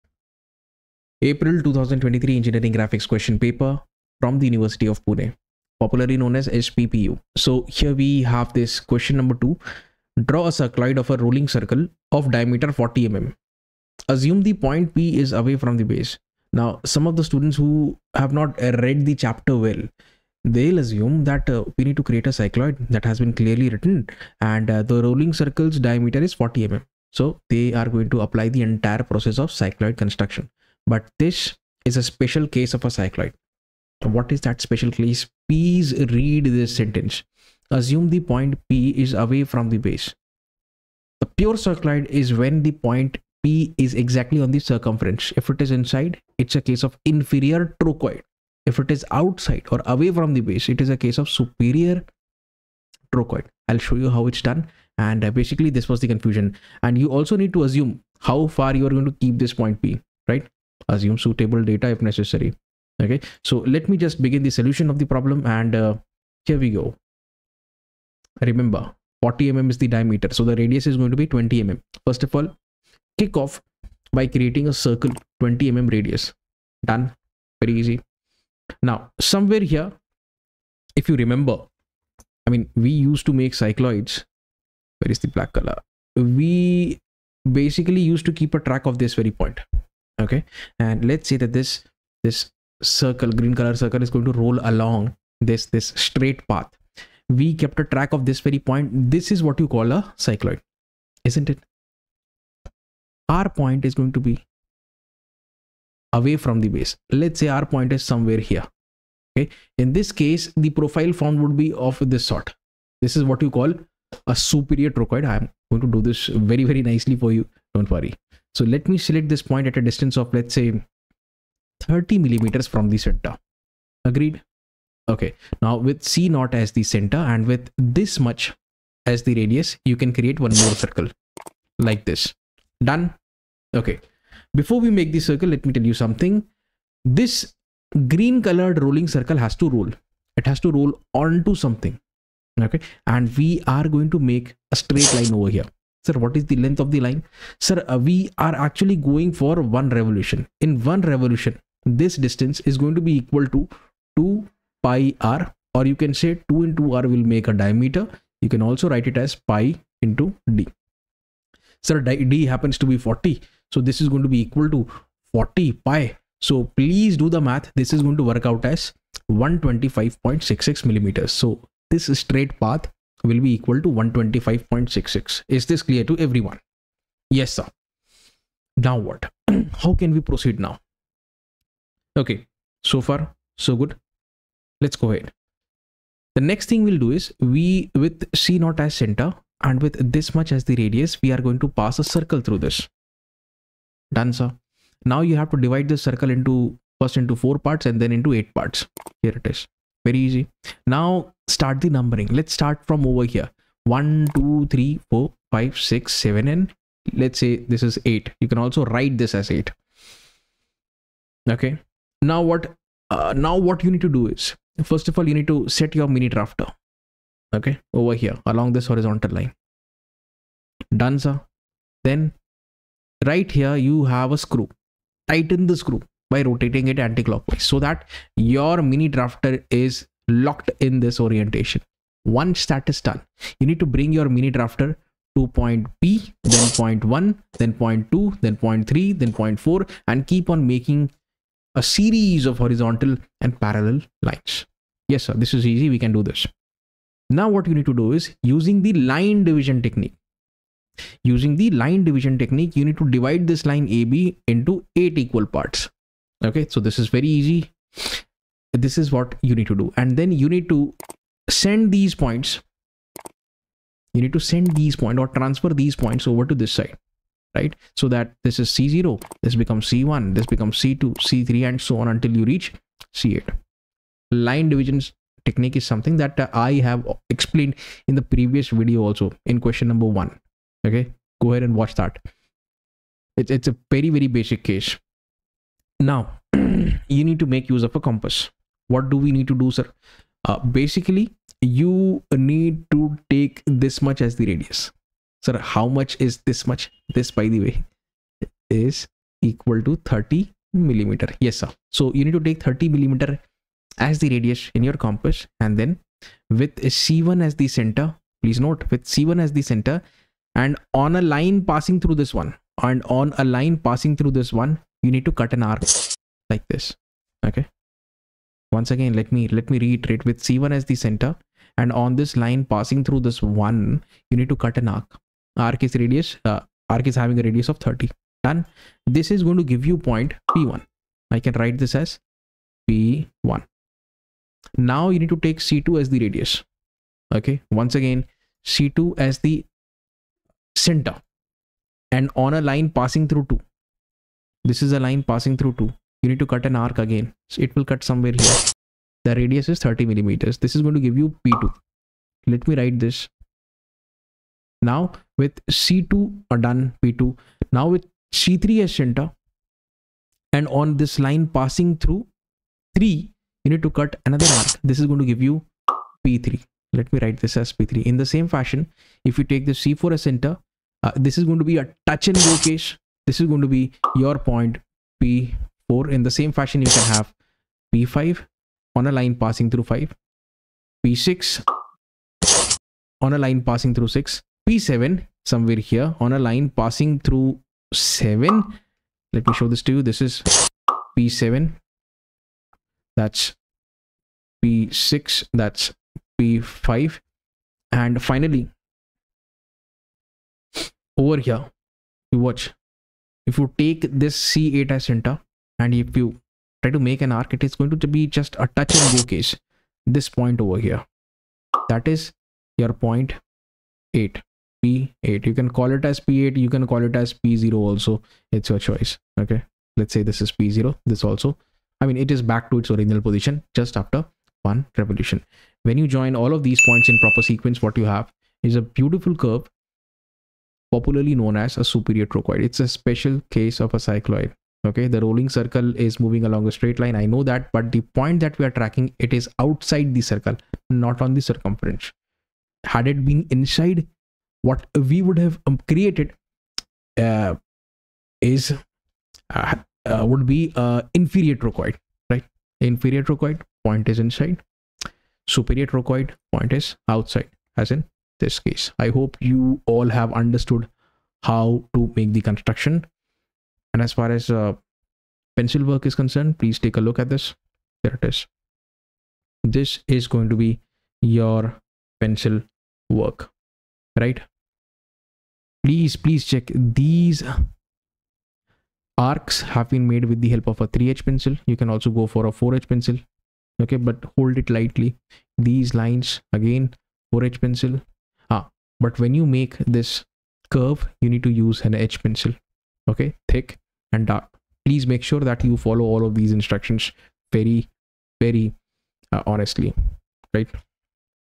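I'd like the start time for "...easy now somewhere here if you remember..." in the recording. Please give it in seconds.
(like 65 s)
77 s.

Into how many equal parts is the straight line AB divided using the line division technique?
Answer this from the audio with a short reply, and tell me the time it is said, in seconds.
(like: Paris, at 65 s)
8, at 254 s.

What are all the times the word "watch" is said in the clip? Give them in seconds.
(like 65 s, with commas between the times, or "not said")
281 s, 402 s.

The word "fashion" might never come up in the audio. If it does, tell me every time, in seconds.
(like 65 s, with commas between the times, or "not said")
368 s, 376 s.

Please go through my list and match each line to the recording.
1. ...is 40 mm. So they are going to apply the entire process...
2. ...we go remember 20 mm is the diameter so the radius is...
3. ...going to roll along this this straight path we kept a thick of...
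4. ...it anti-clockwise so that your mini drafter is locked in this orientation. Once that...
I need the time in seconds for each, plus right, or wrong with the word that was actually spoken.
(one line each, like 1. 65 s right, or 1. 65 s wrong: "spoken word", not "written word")
1. 26 s right
2. 66 s wrong: "40", not "20"
3. 94 s wrong: "track", not "thick"
4. 226 s right.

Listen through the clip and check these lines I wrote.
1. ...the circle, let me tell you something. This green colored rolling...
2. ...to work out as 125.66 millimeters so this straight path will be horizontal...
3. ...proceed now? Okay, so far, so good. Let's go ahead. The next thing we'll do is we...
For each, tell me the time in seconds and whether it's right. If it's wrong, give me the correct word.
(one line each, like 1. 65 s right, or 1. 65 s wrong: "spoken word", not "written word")
1. 135 s right
2. 168 s wrong: "equal", not "horizontal"
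3. 180 s right.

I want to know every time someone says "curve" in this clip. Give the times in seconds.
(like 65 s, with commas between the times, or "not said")
429 s, 490 s.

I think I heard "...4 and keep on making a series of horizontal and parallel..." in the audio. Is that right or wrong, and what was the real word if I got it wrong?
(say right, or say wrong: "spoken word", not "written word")
right.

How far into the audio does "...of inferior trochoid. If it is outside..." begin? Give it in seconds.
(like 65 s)
46 s.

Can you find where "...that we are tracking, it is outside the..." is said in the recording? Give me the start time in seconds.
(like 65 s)
438 s.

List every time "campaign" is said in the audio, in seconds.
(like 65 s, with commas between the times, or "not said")
not said.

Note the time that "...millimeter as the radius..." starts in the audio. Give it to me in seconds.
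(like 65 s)
302 s.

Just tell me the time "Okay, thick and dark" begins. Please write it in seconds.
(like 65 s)
493 s.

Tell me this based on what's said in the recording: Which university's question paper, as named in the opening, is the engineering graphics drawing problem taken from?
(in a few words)
University of Pune.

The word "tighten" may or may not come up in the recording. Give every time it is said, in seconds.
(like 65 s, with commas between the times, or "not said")
225 s.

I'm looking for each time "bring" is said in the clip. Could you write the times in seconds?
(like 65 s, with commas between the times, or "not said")
233 s.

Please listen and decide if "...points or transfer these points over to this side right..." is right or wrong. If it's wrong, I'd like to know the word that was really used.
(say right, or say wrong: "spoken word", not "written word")
right.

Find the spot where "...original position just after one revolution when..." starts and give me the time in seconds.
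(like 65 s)
422 s.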